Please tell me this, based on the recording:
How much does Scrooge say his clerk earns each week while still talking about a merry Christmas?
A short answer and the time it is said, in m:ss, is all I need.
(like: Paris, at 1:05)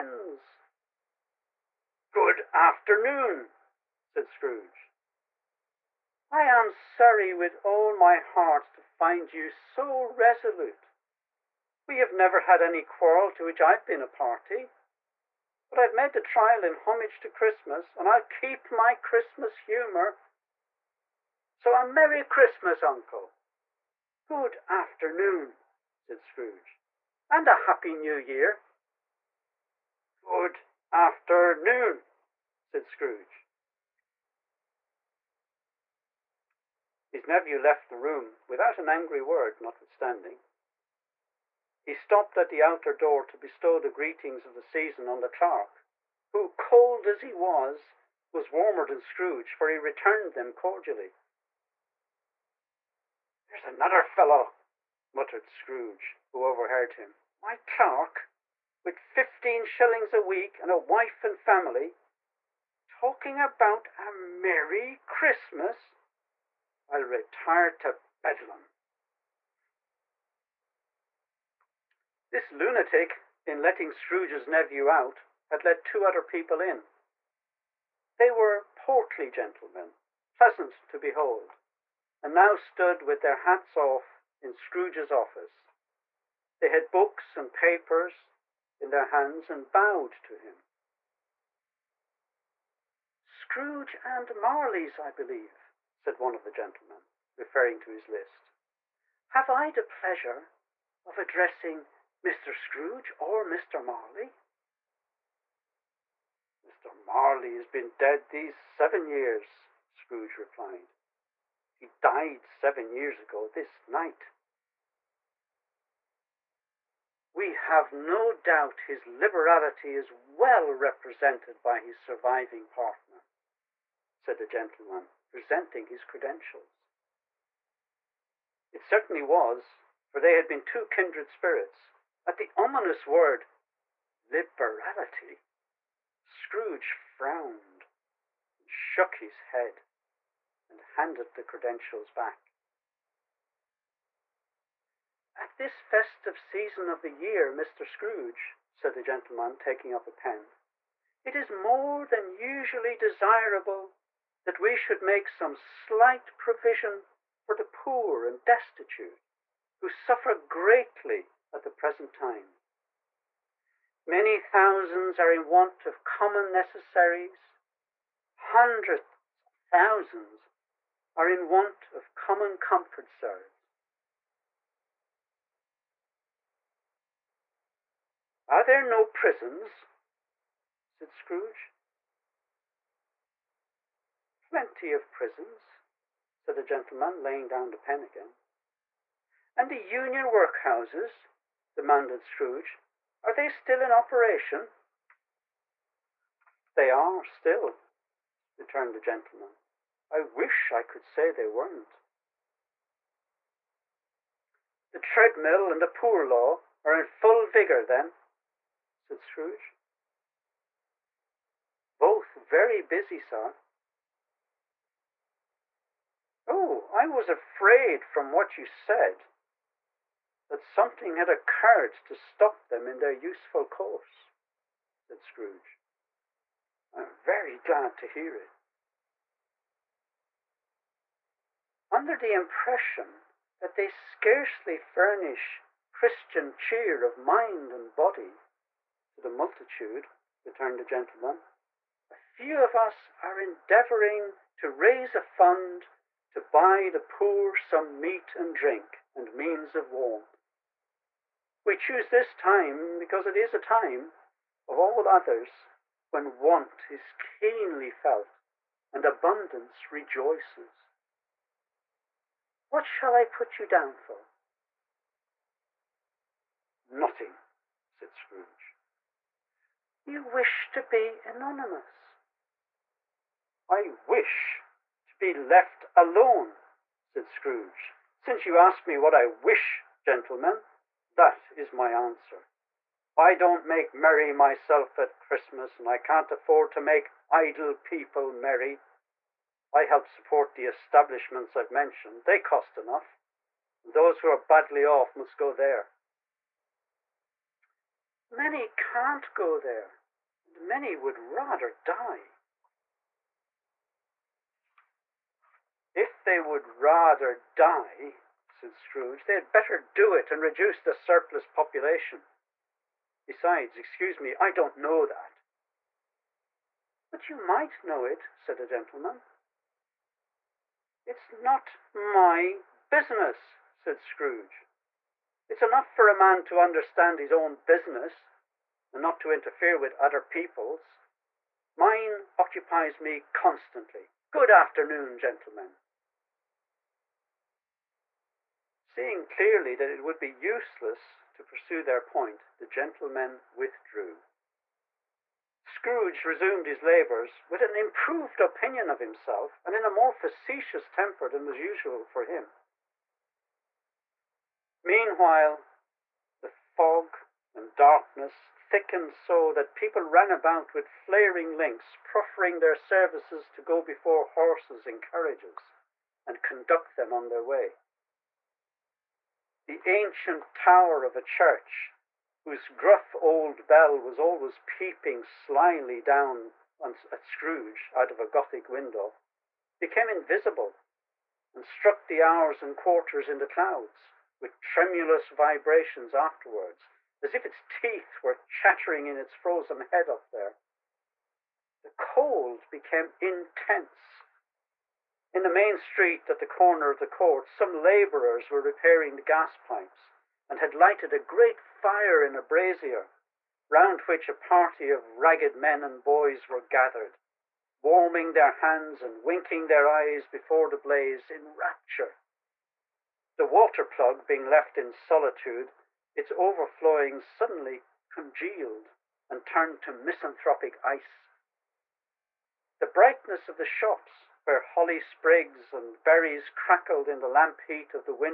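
15 shillings, at 0:58.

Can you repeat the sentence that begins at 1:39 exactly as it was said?
Have I the pleasure of addressing Mr.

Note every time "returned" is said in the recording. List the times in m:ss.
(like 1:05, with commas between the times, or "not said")
0:49, 3:18, 4:00.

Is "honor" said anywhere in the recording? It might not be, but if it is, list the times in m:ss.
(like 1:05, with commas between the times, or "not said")
not said.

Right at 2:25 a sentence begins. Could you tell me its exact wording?
At this festive season of the year, Mr.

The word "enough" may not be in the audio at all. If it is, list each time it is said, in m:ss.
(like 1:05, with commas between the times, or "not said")
4:52, 5:25.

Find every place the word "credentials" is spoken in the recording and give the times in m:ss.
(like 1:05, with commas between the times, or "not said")
2:06, 2:21.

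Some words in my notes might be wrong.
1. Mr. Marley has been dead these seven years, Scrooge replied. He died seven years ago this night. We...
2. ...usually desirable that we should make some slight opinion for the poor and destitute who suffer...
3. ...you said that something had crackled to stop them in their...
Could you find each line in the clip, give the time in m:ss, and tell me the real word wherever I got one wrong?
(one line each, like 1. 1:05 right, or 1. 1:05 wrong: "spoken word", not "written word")
1. 1:46 right
2. 2:32 wrong: "provision", not "opinion"
3. 3:38 wrong: "occurred", not "crackled".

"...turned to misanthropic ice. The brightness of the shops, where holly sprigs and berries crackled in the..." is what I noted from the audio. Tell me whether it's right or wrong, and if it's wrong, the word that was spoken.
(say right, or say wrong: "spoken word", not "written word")
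right.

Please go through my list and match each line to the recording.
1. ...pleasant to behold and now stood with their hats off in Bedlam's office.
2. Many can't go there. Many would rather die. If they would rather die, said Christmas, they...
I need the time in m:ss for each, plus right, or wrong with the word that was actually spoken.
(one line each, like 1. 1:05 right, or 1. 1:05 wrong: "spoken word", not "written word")
1. 1:20 wrong: "Scrooge", not "Bedlam"
2. 4:58 wrong: "Scrooge", not "Christmas".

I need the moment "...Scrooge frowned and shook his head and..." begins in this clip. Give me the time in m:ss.
2:16.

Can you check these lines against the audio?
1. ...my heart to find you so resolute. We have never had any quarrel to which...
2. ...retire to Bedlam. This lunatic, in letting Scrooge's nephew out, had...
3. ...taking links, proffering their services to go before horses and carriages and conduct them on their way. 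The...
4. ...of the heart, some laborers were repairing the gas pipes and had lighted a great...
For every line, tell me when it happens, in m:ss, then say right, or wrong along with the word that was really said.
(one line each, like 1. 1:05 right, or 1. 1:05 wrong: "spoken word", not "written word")
1. 0:07 right
2. 1:07 right
3. 6:00 wrong: "flaring", not "taking"
4. 6:36 wrong: "court", not "heart".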